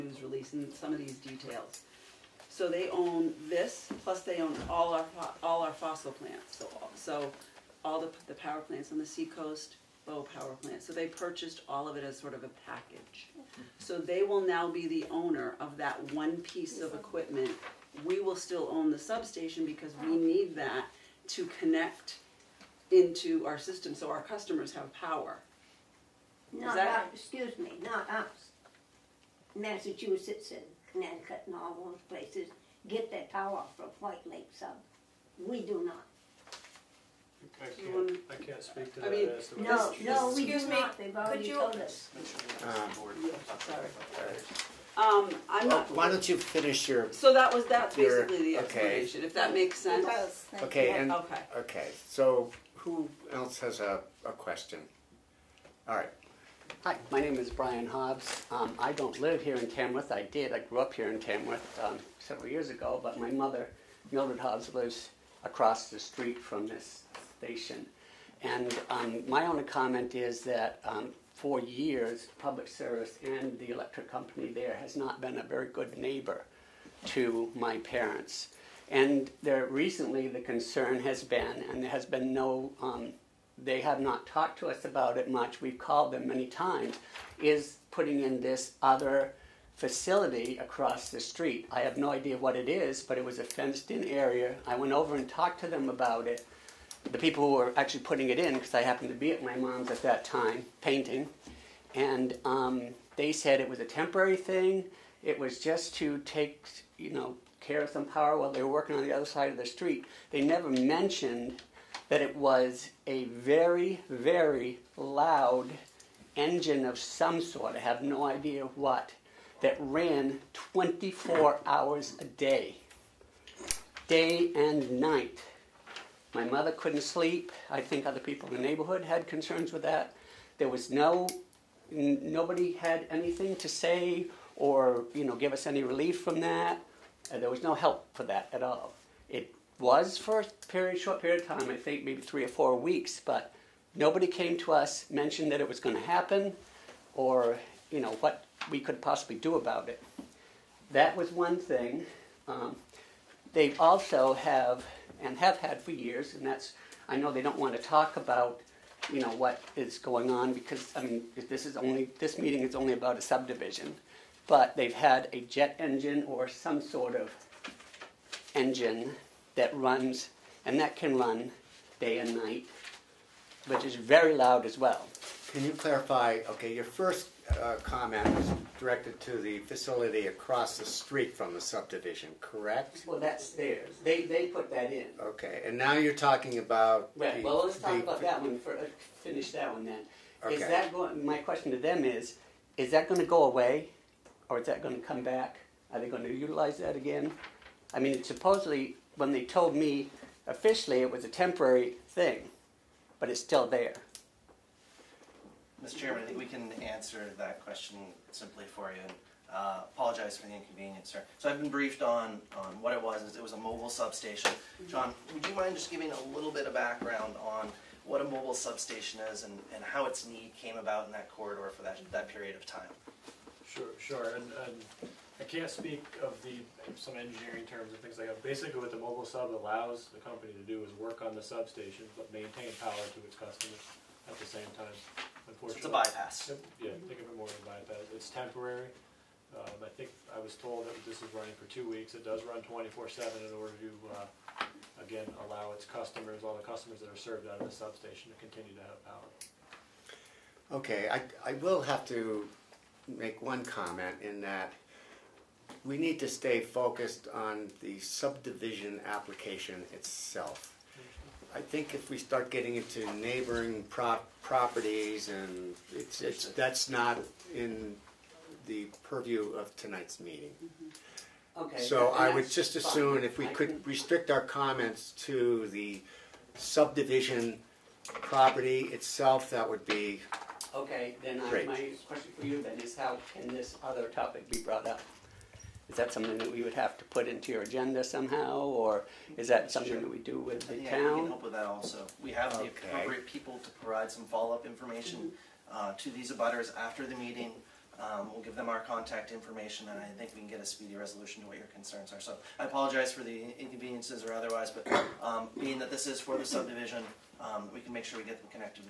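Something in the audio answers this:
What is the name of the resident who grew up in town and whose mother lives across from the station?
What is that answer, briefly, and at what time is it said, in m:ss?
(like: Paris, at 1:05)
Brian Hobbs, at 0:57.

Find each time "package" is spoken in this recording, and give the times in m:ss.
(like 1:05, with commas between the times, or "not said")
0:12.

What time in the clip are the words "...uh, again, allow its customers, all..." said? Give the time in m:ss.
4:04.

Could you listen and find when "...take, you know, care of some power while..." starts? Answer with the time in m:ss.
1:46.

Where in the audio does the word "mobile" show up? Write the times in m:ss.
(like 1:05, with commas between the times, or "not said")
3:33, 3:38, 3:48.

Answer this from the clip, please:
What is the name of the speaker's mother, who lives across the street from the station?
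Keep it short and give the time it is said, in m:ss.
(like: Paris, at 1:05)
Mildred Hobbs, at 1:04.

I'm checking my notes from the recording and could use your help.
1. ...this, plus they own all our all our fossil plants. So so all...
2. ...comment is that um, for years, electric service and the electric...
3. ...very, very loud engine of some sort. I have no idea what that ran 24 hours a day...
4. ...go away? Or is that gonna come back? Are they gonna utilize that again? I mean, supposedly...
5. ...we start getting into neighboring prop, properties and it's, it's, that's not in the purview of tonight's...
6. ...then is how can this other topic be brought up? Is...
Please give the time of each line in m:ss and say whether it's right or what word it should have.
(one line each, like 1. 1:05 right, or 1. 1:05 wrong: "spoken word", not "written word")
1. 0:03 right
2. 1:09 wrong: "public", not "electric"
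3. 1:53 right
4. 3:13 right
5. 4:22 right
6. 4:42 right.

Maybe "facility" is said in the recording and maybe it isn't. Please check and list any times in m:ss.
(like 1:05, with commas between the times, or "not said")
1:29, 2:59.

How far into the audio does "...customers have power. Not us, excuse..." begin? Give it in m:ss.
0:24.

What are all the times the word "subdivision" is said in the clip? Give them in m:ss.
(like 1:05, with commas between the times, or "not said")
2:43, 3:01, 4:17, 4:36, 5:06.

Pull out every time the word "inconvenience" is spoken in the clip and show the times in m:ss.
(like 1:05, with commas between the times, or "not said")
3:30, 5:03.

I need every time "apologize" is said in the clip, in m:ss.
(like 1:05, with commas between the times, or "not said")
3:29, 5:02.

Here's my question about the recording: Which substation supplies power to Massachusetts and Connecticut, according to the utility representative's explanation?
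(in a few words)
White Lake Sub.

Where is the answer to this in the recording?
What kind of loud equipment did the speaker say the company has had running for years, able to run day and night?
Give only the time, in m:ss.
2:45.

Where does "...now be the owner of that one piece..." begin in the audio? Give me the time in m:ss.
0:14.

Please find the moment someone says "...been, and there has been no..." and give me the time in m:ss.
1:21.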